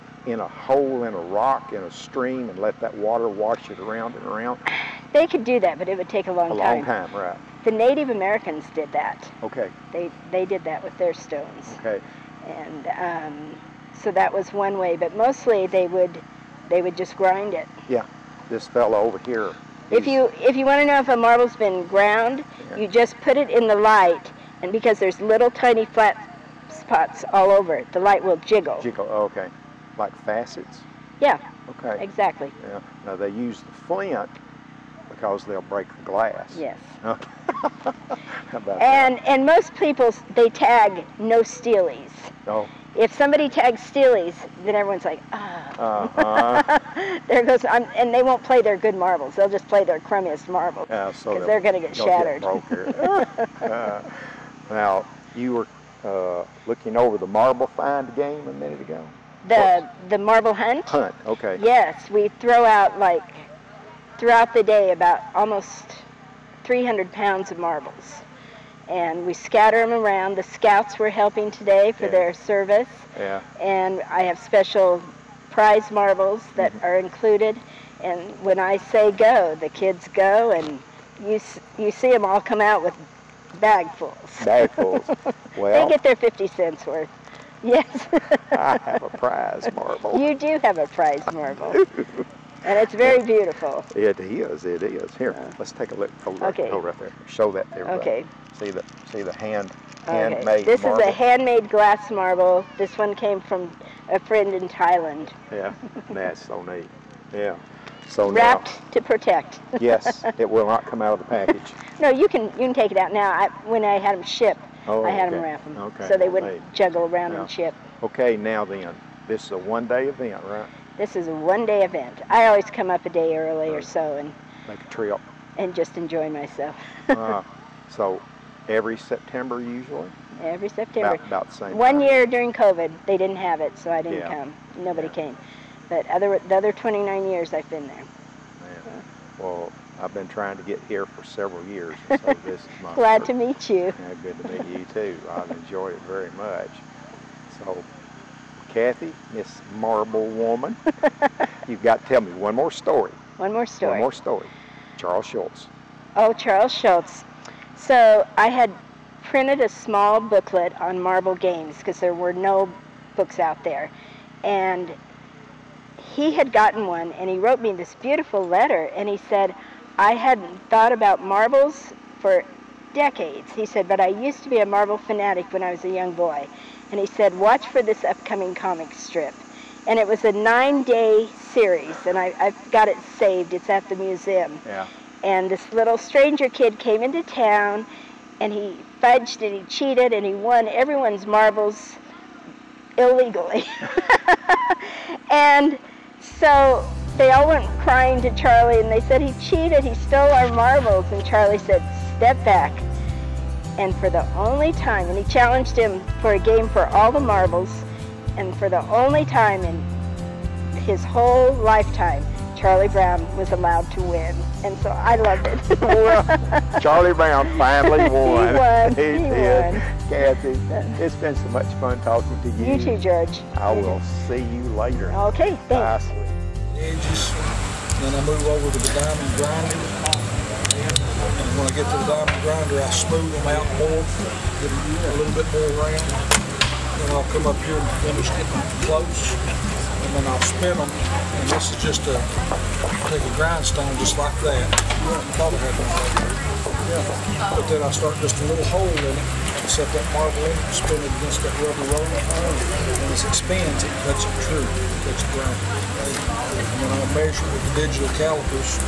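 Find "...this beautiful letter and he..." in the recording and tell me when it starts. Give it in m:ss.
2:47.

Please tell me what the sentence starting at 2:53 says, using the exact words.
He said, but I used to be a Marvel fanatic when I was a young boy.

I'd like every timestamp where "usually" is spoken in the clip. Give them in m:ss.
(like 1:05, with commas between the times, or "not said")
2:09.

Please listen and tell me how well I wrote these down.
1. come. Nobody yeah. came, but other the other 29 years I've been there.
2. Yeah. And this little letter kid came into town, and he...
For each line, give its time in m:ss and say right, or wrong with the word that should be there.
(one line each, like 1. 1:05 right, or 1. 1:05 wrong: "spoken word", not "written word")
1. 2:14 right
2. 3:04 wrong: "stranger", not "letter".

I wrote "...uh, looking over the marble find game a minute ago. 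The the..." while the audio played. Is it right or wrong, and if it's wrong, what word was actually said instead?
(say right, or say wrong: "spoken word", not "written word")
right.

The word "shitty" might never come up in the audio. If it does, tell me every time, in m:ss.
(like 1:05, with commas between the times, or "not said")
not said.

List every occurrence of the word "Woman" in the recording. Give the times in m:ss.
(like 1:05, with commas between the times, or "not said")
2:30.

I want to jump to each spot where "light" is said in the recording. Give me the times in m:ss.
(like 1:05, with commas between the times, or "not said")
0:23, 0:27.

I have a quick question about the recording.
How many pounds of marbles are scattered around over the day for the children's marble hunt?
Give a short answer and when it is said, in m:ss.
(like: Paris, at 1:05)
300, at 1:06.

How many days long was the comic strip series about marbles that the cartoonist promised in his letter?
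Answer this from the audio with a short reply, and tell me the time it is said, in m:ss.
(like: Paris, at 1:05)
9, at 3:00.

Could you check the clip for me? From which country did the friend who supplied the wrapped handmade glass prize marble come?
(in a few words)
Thailand.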